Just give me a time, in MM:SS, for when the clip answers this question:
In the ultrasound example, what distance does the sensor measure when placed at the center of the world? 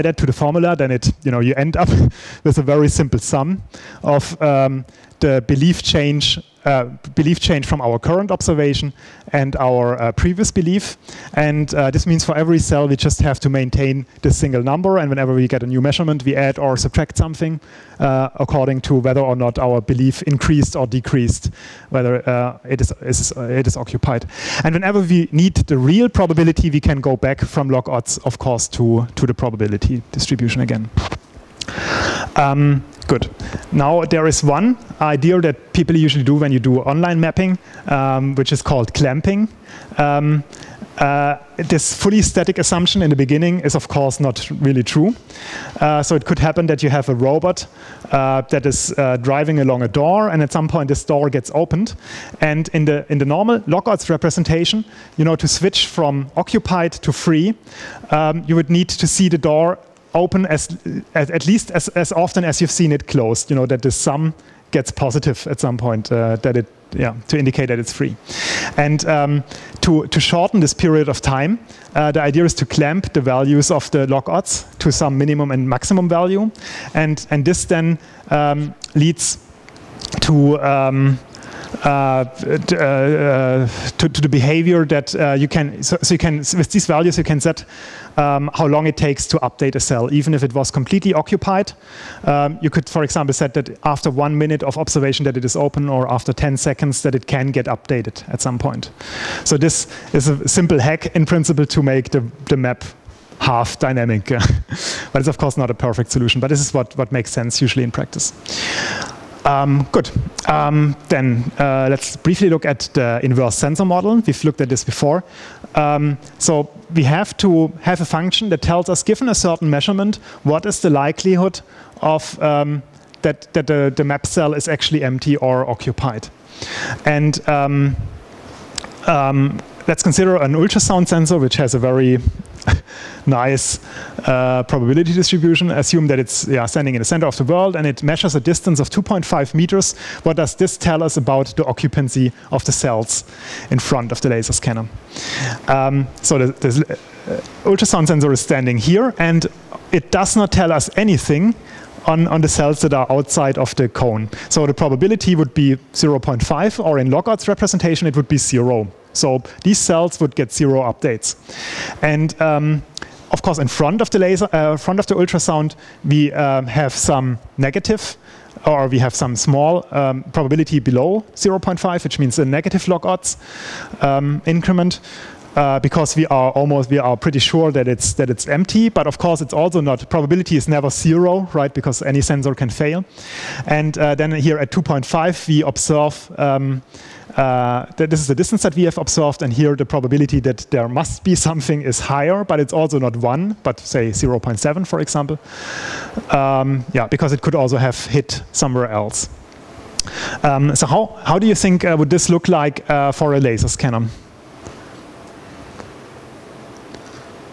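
02:18.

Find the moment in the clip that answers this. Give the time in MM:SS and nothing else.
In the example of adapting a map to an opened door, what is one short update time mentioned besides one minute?
01:36.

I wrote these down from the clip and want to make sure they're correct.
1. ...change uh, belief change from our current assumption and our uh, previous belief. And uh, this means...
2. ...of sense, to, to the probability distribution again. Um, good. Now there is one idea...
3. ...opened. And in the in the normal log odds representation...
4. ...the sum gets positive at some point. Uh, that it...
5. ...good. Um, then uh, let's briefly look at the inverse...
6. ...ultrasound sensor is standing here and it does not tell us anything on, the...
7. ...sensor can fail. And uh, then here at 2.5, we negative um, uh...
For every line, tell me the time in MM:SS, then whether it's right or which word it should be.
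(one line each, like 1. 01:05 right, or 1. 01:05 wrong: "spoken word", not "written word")
1. 00:05 wrong: "observation", not "assumption"
2. 00:28 wrong: "course", not "sense"
3. 00:51 right
4. 01:03 right
5. 01:49 right
6. 02:27 right
7. 03:02 wrong: "observe", not "negative".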